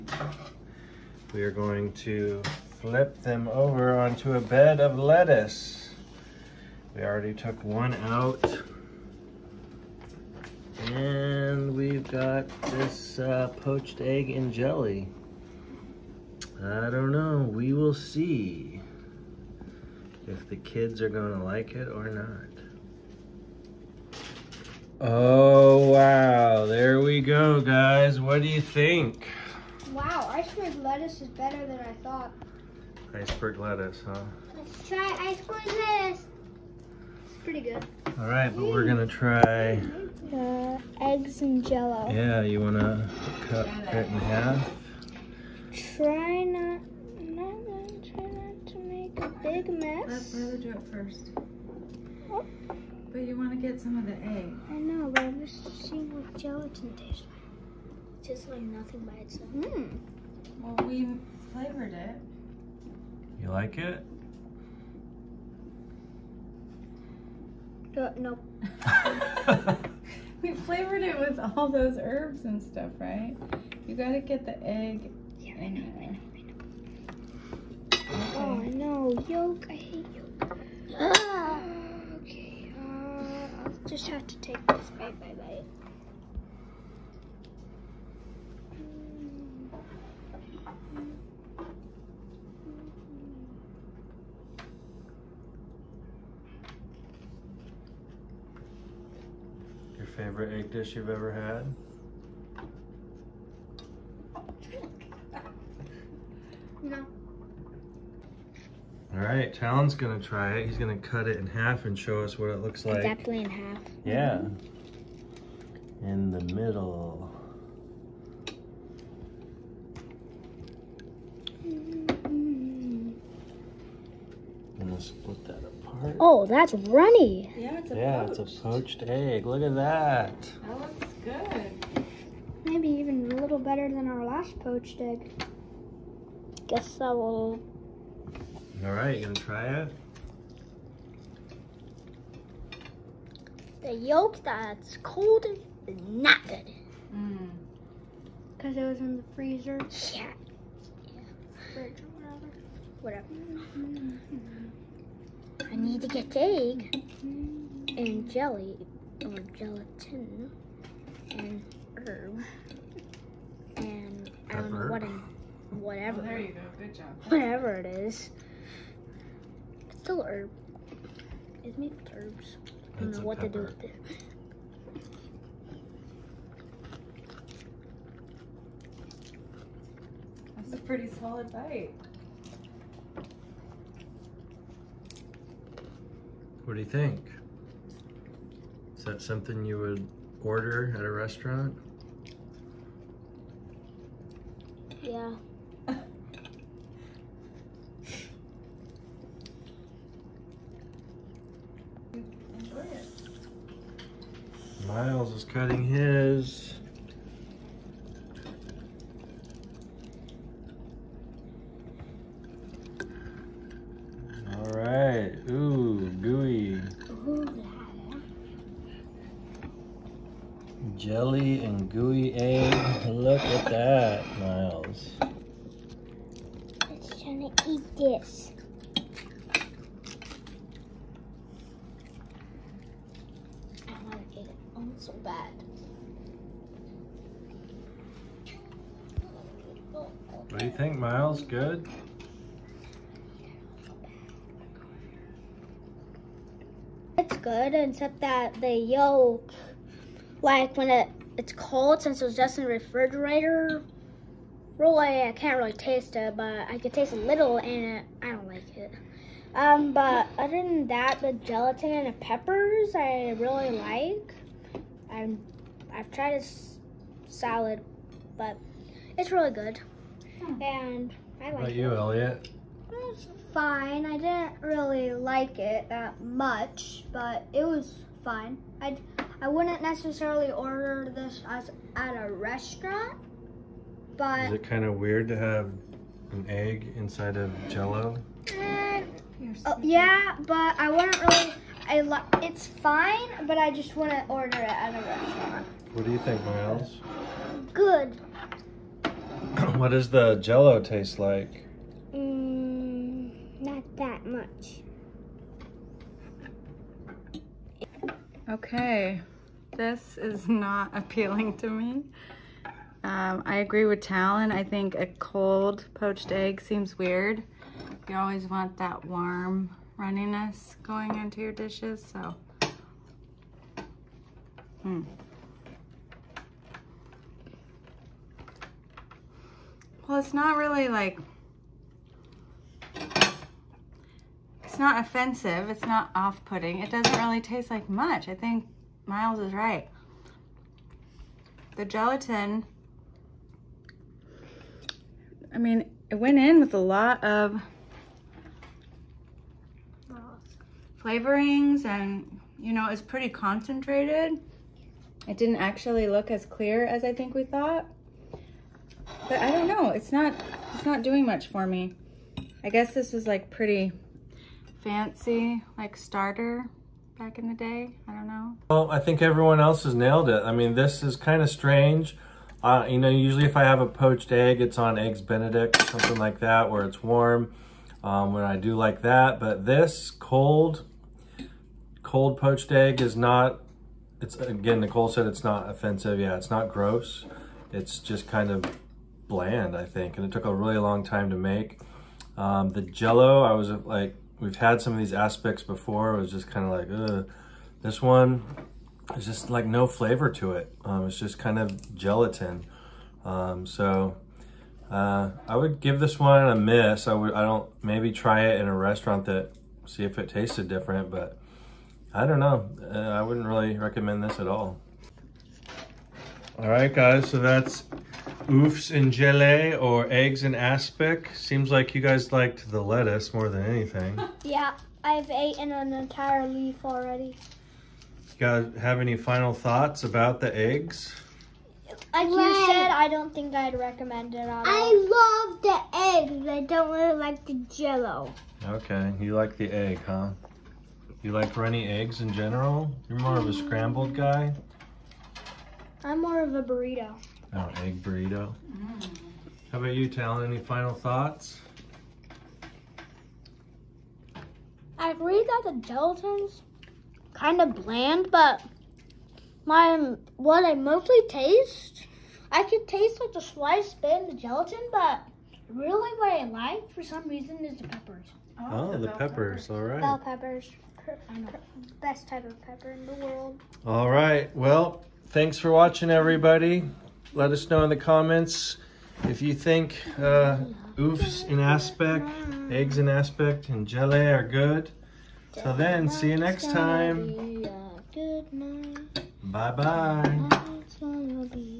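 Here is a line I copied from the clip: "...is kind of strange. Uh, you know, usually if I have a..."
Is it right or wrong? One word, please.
right.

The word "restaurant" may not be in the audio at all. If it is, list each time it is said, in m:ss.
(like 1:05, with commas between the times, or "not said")
3:11, 4:42, 4:55, 6:48.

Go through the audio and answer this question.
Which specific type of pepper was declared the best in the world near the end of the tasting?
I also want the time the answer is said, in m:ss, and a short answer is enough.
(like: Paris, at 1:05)
Bell peppers, at 7:49.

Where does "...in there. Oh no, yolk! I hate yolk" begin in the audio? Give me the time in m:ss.
1:15.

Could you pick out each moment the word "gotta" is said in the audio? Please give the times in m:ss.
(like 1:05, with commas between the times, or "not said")
1:13.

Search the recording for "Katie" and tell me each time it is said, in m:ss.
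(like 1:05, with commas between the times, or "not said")
not said.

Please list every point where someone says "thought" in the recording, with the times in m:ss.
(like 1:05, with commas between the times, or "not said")
0:32, 5:57, 7:09, 7:30.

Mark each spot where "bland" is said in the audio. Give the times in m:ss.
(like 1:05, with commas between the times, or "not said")
6:29, 7:37.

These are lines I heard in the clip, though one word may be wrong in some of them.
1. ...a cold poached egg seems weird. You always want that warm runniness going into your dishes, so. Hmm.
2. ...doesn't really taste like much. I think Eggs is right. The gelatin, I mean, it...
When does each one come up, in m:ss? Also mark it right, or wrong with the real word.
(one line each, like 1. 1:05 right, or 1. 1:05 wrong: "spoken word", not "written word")
1. 5:14 right
2. 5:36 wrong: "Miles", not "Eggs".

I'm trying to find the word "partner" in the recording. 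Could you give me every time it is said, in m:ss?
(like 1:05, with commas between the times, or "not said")
not said.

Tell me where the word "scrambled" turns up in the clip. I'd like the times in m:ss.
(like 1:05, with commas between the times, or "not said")
7:23.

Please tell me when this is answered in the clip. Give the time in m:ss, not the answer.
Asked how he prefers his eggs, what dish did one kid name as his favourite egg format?
7:27.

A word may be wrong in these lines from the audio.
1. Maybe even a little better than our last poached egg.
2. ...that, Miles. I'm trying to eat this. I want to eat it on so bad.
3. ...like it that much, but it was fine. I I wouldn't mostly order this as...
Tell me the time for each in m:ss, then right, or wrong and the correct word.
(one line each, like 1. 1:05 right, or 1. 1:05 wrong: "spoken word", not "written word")
1. 2:12 right
2. 3:43 right
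3. 4:35 wrong: "necessarily", not "mostly".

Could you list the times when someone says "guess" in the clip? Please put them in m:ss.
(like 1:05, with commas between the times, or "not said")
2:16, 6:02.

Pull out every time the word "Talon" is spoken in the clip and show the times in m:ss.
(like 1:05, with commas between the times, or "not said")
1:49, 5:14, 7:30.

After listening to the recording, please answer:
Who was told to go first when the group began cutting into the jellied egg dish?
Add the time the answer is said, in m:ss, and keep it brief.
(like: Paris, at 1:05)
Ryla, at 0:50.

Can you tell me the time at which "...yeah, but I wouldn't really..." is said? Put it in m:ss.
4:49.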